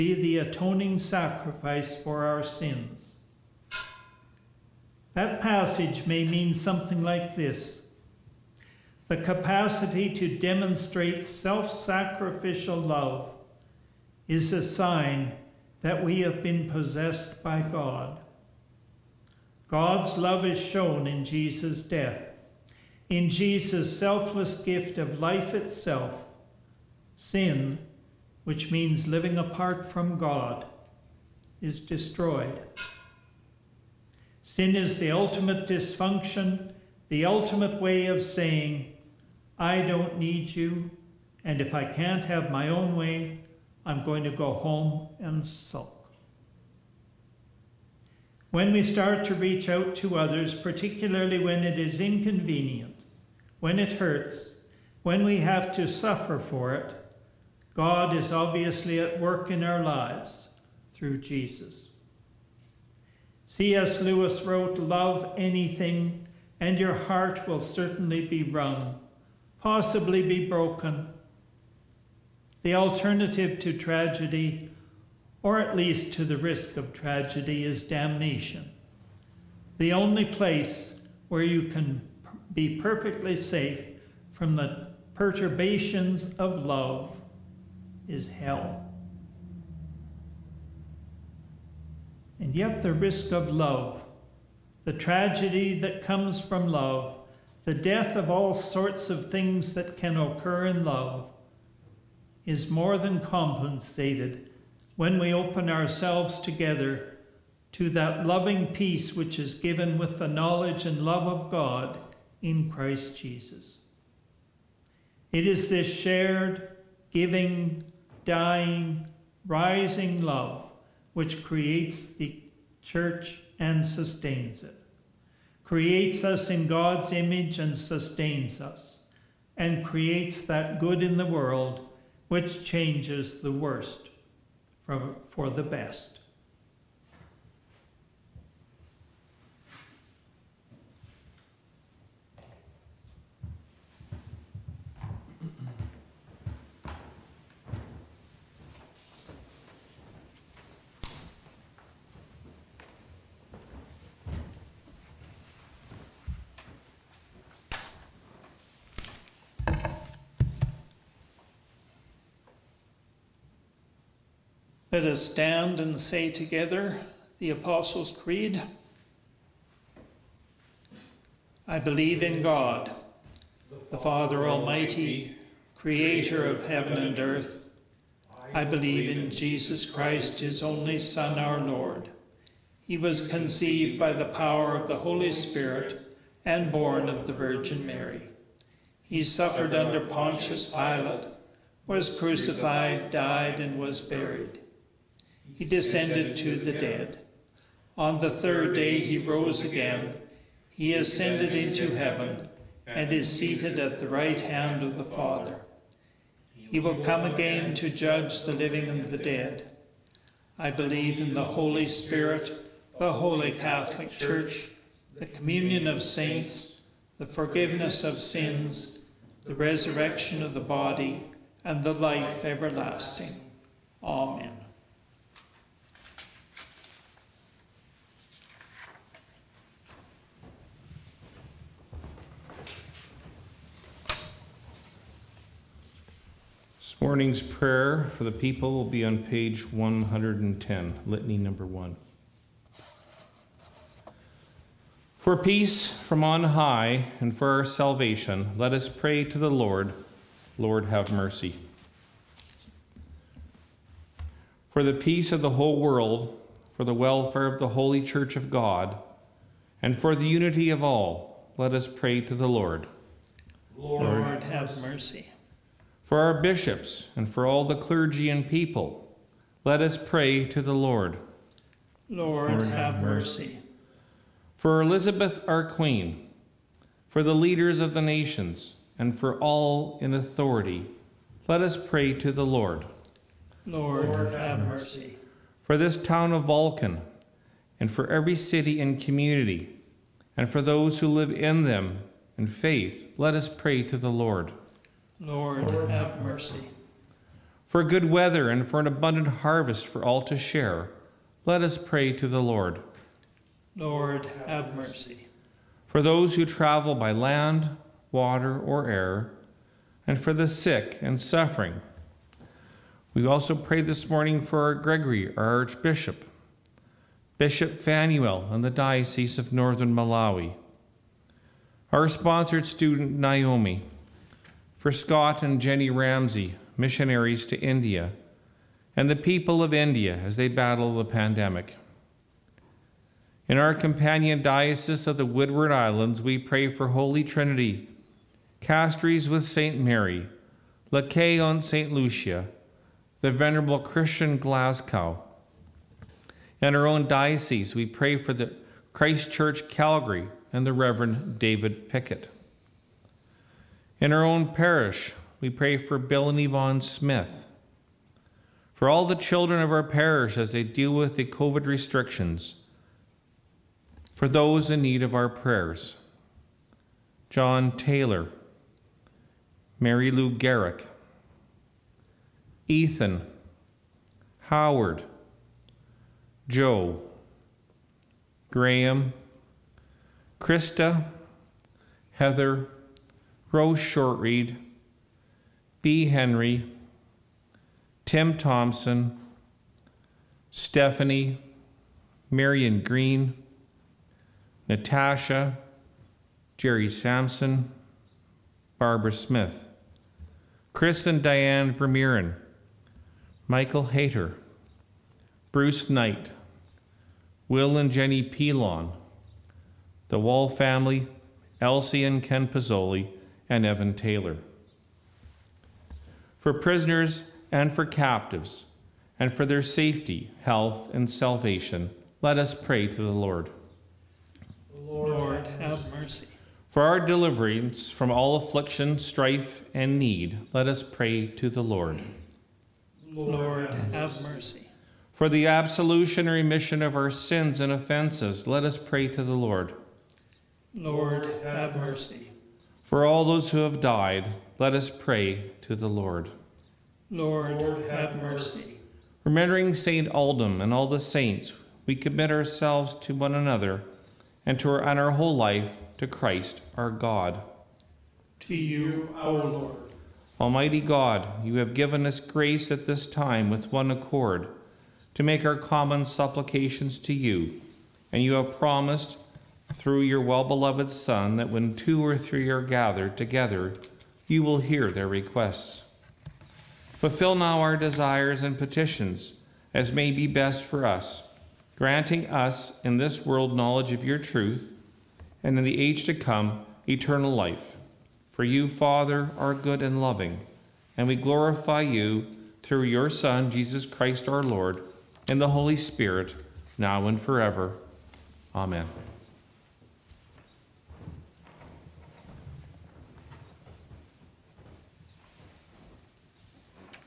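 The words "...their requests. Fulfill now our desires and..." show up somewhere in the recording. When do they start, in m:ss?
7:54.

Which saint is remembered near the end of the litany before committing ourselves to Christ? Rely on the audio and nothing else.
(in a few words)
St. Aldhelm.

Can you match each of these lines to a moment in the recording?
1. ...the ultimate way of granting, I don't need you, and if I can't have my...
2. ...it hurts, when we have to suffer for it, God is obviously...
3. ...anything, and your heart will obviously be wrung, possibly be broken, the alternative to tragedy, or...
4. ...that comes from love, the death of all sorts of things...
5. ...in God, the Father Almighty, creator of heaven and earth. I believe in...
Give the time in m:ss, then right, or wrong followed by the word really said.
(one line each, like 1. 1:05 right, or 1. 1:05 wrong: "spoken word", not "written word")
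1. 0:37 wrong: "saying", not "granting"
2. 0:53 right
3. 1:05 wrong: "certainly", not "obviously"
4. 1:35 right
5. 2:52 right.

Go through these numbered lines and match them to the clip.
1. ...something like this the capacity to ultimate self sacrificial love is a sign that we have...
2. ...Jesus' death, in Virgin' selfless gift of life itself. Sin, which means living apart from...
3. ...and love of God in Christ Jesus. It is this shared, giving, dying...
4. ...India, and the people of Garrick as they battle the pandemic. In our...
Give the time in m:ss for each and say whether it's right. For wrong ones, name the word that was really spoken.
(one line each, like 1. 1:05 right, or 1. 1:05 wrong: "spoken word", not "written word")
1. 0:06 wrong: "demonstrate", not "ultimate"
2. 0:21 wrong: "Jesus", not "Virgin"
3. 1:50 right
4. 5:27 wrong: "India", not "Garrick".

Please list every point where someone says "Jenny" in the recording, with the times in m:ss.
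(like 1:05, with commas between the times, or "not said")
5:25, 6:47.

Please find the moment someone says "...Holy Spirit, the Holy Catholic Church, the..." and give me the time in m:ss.
3:31.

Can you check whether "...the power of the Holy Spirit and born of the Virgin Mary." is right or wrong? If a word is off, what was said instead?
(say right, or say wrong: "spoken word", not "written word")
right.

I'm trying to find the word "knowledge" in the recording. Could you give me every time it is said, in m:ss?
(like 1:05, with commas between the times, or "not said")
1:50, 8:03.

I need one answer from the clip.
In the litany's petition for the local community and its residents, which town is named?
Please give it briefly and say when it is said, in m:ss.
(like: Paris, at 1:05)
Vulcan, at 4:46.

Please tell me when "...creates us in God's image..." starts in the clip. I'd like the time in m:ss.
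2:05.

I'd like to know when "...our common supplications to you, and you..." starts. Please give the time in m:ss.
7:45.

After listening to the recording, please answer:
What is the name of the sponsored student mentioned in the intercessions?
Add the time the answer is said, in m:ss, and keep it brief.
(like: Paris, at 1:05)
Naomi, at 5:23.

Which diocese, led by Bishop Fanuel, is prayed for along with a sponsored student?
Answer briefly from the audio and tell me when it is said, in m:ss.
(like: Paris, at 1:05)
Northern Malawi, at 5:19.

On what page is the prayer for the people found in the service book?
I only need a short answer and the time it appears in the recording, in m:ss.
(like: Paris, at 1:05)
110, at 3:59.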